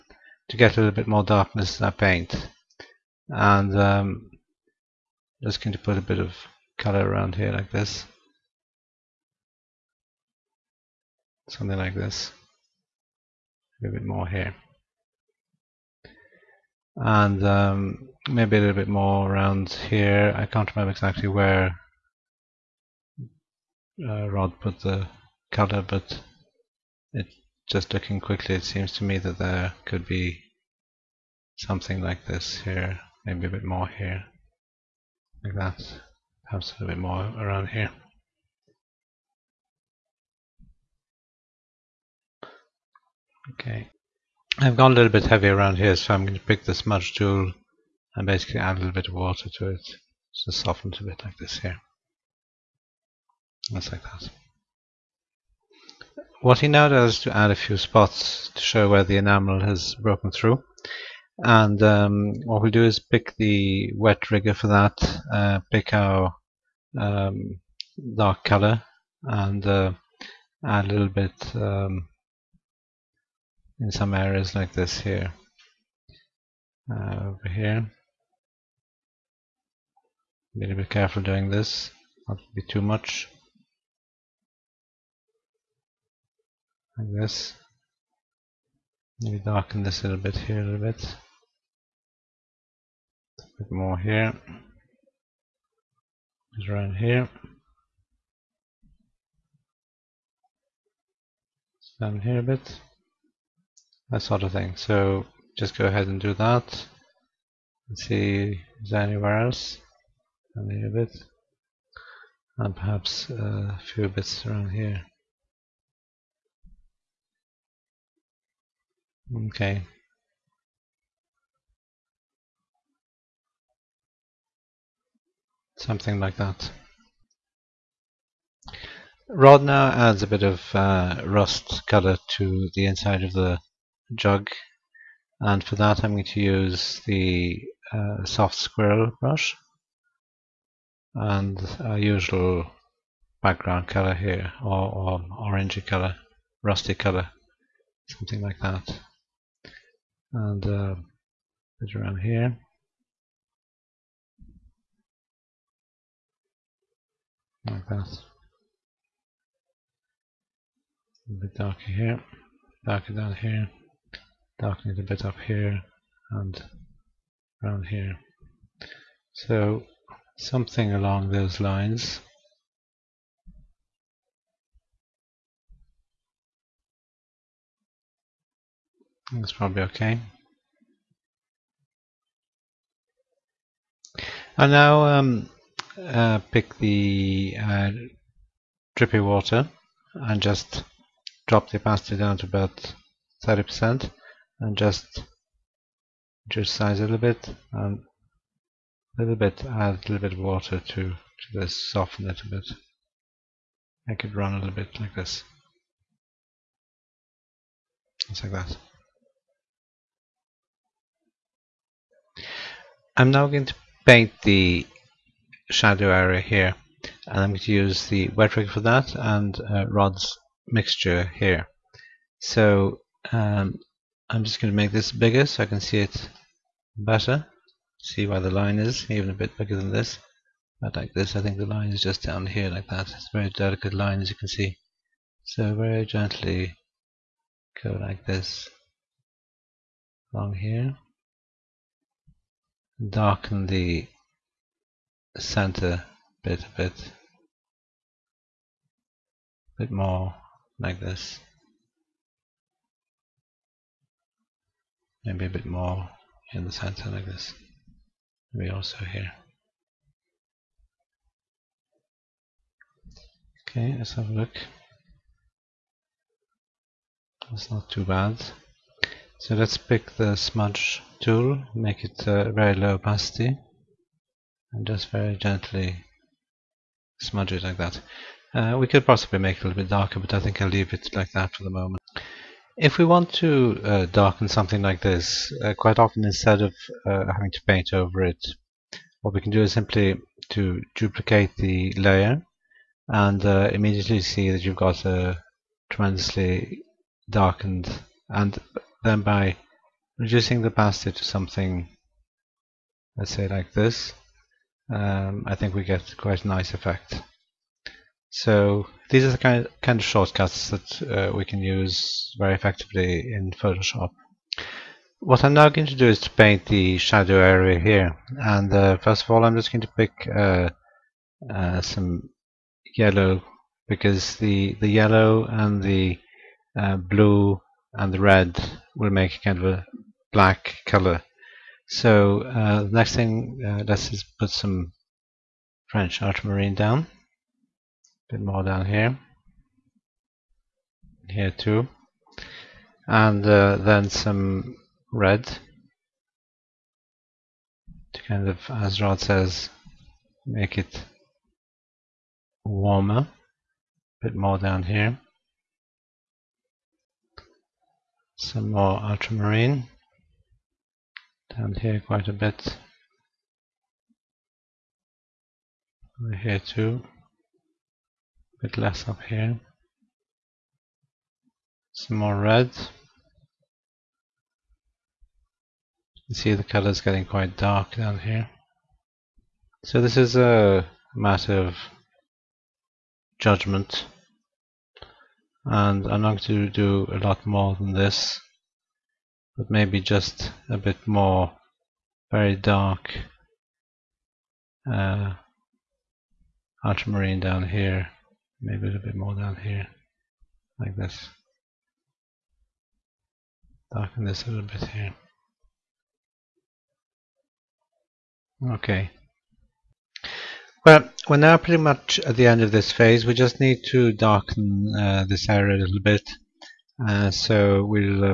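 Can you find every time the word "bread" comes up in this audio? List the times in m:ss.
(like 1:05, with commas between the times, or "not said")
not said.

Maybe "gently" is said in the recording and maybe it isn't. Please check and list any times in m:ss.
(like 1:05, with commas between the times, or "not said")
3:56, 4:35.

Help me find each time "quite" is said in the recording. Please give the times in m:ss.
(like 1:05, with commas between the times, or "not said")
4:45, 5:06, 6:02, 6:17.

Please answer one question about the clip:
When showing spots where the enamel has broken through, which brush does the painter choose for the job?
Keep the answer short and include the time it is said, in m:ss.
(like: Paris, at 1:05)
wet rigger, at 1:03.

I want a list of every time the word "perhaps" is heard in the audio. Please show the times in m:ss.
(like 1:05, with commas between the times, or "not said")
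0:36, 1:52.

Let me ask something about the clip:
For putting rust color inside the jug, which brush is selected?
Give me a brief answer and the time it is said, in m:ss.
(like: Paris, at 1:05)
soft squirrel brush, at 2:18.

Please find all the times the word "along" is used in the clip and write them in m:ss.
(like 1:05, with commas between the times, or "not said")
2:50, 4:00.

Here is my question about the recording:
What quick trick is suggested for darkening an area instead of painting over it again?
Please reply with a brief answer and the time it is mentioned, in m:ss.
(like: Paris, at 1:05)
duplicate the layer, at 4:50.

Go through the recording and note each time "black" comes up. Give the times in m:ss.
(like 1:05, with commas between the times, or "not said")
5:30.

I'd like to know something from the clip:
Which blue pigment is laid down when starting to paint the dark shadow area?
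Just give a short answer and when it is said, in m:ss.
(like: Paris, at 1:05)
French ultramarine, at 5:35.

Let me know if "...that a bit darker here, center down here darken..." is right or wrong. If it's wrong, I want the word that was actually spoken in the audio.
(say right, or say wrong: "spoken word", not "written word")
wrong: "darker", not "center".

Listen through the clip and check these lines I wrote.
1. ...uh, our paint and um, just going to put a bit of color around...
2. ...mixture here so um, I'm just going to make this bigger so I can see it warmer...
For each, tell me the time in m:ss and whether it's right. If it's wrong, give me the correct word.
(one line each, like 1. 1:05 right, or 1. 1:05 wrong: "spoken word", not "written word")
1. 0:01 right
2. 3:40 wrong: "better", not "warmer".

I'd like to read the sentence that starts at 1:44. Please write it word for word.
So just go ahead and do that.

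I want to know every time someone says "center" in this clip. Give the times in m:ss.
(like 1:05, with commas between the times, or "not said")
4:05, 4:16.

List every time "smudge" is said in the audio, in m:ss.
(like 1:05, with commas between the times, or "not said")
0:46, 4:30, 4:37.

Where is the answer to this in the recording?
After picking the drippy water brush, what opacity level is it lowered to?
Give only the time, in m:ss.
3:13.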